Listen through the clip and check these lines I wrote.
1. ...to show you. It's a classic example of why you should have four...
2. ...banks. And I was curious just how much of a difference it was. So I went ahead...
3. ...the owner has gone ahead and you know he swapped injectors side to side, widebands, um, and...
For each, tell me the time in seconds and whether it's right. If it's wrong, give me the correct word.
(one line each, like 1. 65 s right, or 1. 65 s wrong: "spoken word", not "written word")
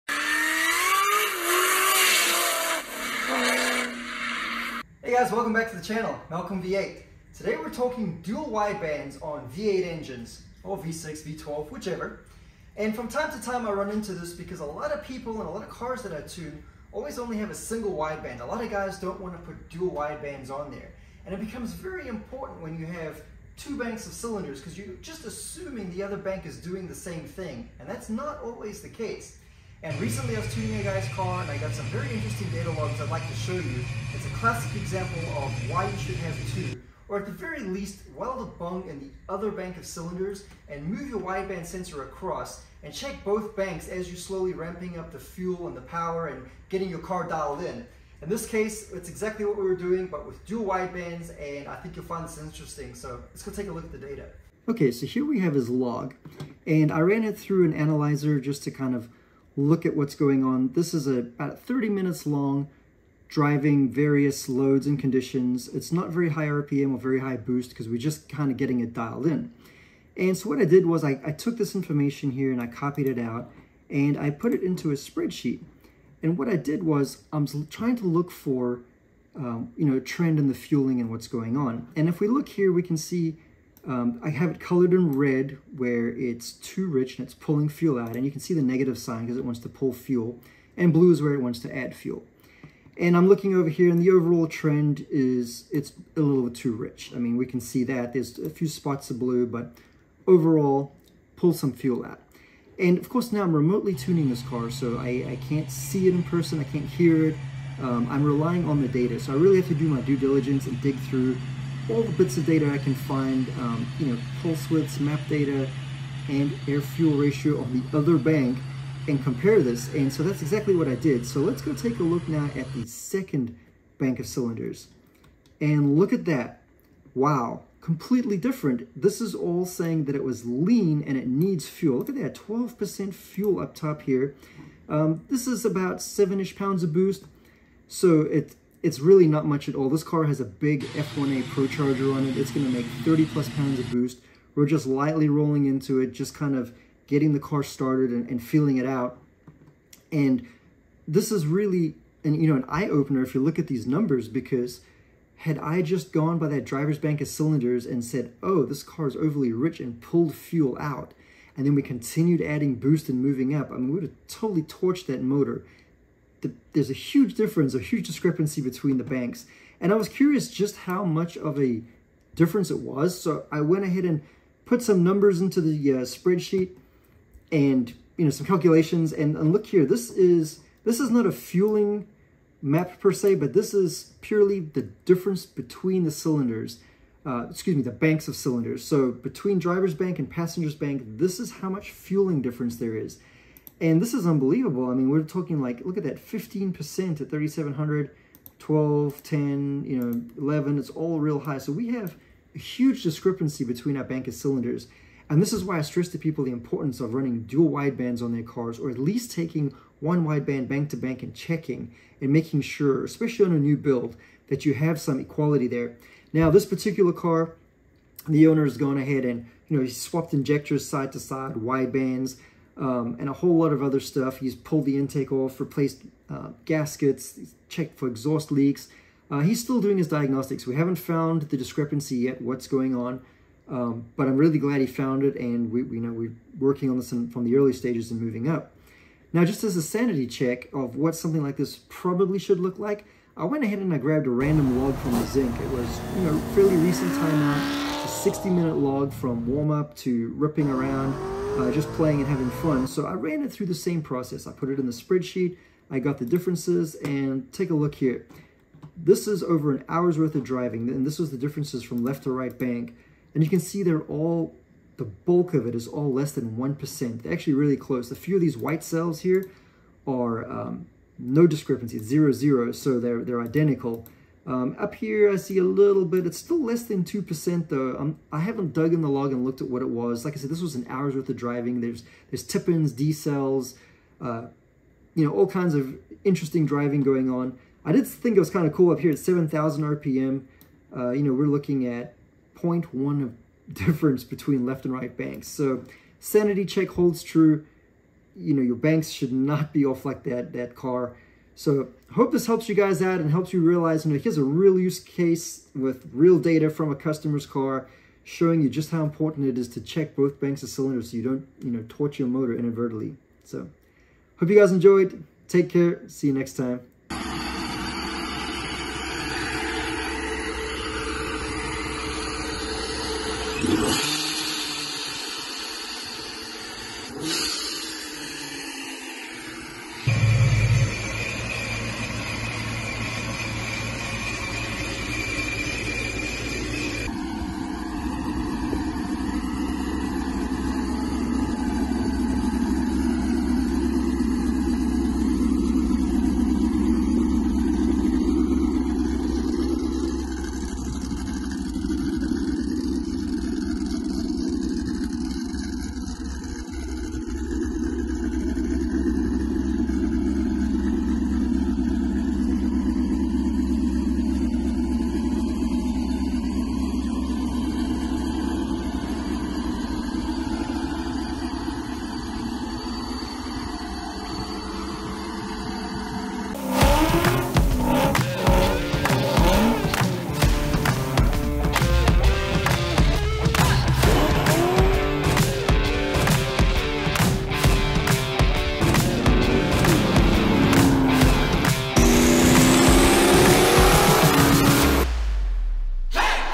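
1. 33 s wrong: "two", not "four"
2. 169 s right
3. 218 s right.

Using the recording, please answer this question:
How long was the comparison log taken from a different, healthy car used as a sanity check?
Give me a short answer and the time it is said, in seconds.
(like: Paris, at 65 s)
60 minutes, at 248 s.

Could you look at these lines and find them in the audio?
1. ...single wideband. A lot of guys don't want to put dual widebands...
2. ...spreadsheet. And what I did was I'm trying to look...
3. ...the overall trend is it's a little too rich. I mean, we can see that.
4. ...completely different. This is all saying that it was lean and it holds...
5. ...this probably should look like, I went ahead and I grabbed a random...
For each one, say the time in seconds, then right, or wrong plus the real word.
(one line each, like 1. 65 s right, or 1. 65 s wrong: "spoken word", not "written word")
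1. 17 s right
2. 74 s right
3. 94 s right
4. 127 s wrong: "needs", not "holds"
5. 241 s right.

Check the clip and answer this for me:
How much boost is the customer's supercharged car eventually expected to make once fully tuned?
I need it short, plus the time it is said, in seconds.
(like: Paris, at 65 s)
30 plus pounds, at 143 s.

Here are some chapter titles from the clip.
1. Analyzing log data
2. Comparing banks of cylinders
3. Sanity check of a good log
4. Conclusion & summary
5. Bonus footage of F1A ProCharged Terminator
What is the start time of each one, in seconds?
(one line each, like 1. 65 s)
1. 54 s
2. 165 s
3. 238 s
4. 295 s
5. 316 s.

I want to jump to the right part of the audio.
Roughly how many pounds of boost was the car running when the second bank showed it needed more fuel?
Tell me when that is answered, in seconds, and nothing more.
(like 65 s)
136 s.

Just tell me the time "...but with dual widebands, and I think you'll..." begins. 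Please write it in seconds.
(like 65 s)
50 s.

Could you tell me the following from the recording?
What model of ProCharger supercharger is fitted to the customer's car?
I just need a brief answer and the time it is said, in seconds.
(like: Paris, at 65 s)
F1A, at 140 s.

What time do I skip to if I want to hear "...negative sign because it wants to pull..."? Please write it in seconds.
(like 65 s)
88 s.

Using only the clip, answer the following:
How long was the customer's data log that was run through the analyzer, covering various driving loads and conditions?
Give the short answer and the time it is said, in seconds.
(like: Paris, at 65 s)
30 minutes, at 61 s.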